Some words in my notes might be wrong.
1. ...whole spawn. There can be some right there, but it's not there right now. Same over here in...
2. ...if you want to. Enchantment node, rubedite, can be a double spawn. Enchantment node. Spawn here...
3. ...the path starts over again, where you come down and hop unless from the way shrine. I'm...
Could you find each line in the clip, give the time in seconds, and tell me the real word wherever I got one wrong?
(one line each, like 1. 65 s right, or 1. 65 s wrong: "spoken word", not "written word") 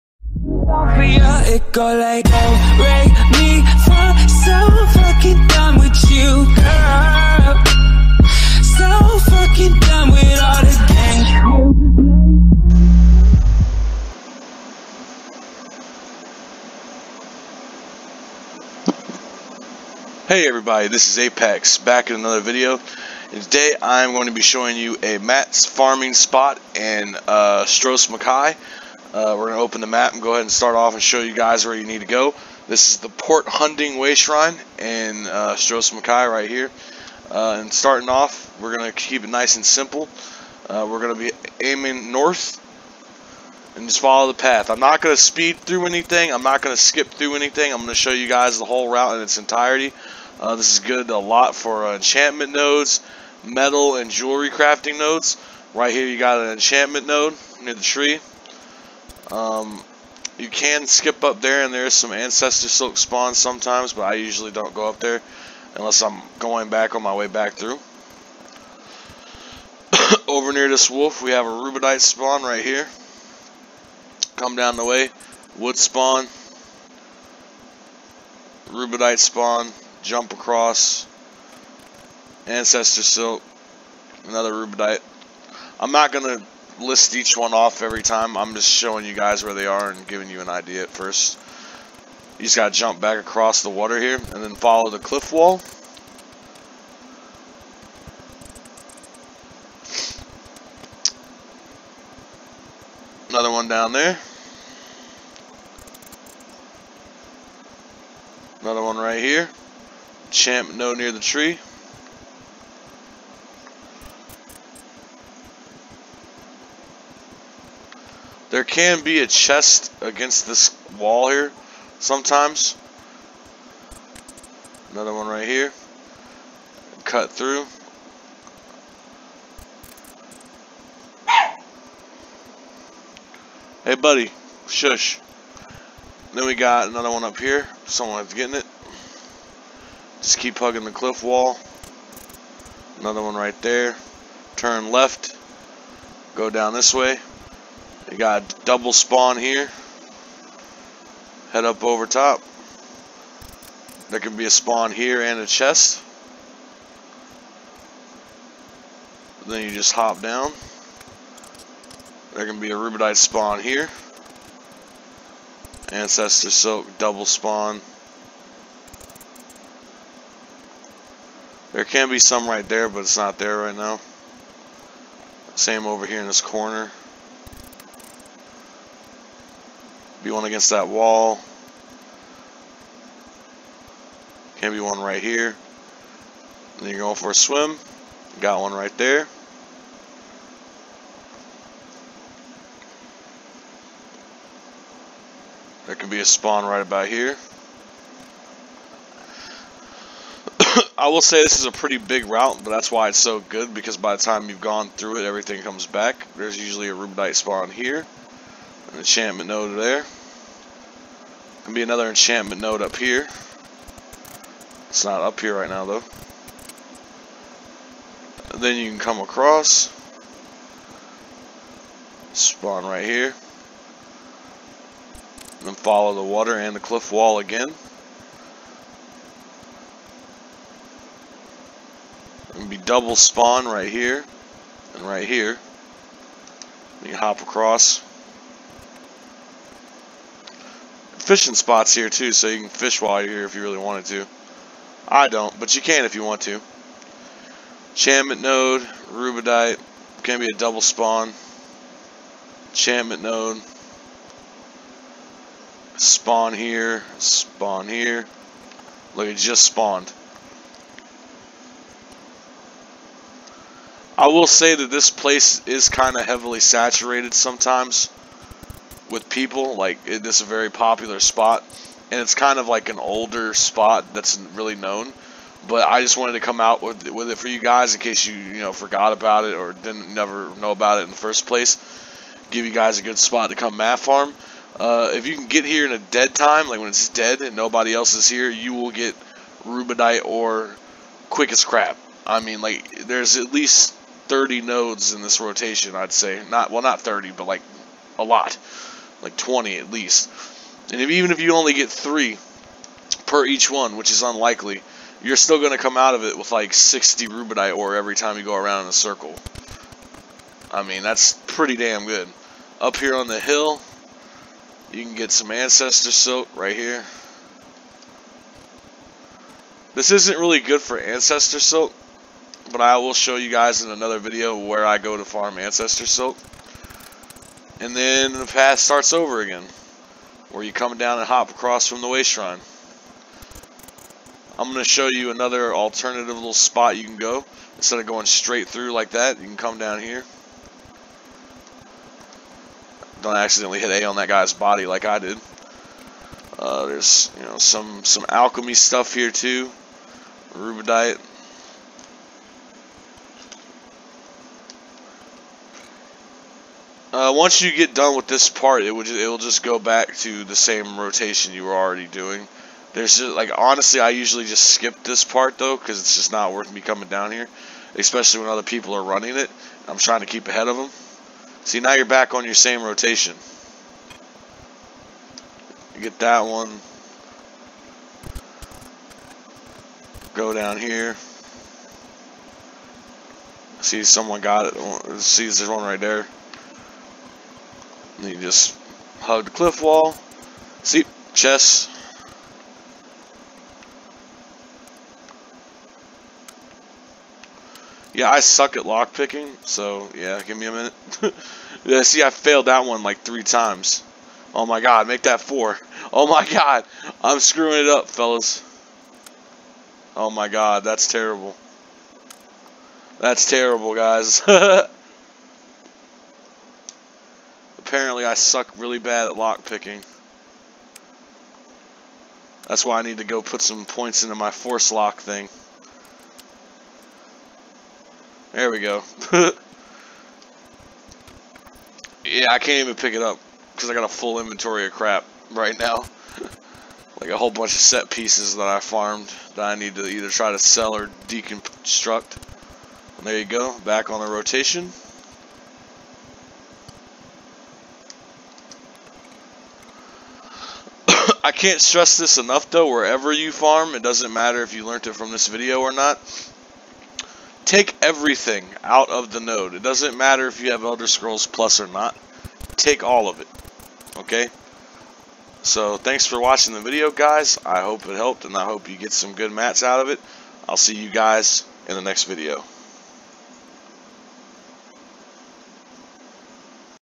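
1. 166 s wrong: "double", not "whole"
2. 246 s right
3. 328 s wrong: "across", not "unless".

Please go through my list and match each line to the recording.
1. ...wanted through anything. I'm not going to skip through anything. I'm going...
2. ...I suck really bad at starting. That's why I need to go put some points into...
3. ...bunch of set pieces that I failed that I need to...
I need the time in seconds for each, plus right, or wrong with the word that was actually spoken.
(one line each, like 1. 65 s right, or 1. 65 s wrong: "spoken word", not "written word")
1. 45 s wrong: "speed", not "wanted"
2. 418 s wrong: "lockpicking", not "starting"
3. 437 s wrong: "farmed", not "failed".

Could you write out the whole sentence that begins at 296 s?
Not well, not 30, but like a lot like 20 at least.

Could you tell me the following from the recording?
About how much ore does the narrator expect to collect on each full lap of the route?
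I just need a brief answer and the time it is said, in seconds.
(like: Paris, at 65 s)
60 Rubedite ore, at 306 s.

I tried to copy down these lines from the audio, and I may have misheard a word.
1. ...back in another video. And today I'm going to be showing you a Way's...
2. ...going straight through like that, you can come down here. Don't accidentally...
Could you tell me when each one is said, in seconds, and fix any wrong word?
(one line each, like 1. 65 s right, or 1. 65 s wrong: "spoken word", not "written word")
1. 21 s wrong: "Matt", not "Way"
2. 338 s right.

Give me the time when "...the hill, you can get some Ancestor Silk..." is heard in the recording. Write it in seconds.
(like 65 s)
313 s.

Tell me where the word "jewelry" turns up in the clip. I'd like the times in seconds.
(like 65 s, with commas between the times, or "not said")
54 s.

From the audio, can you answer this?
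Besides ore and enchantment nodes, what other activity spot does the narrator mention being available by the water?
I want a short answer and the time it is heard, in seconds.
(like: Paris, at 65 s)
Fishing spots, at 241 s.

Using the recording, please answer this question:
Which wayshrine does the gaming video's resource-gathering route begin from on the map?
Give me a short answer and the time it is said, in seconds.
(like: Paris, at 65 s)
Port Hunding, at 33 s.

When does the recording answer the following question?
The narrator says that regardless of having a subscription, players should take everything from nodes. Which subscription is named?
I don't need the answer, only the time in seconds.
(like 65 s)
460 s.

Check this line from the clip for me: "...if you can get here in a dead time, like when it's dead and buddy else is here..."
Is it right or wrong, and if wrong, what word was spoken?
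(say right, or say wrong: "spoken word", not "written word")
wrong: "nobody", not "buddy".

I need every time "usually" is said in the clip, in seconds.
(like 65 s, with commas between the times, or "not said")
64 s, 206 s, 364 s.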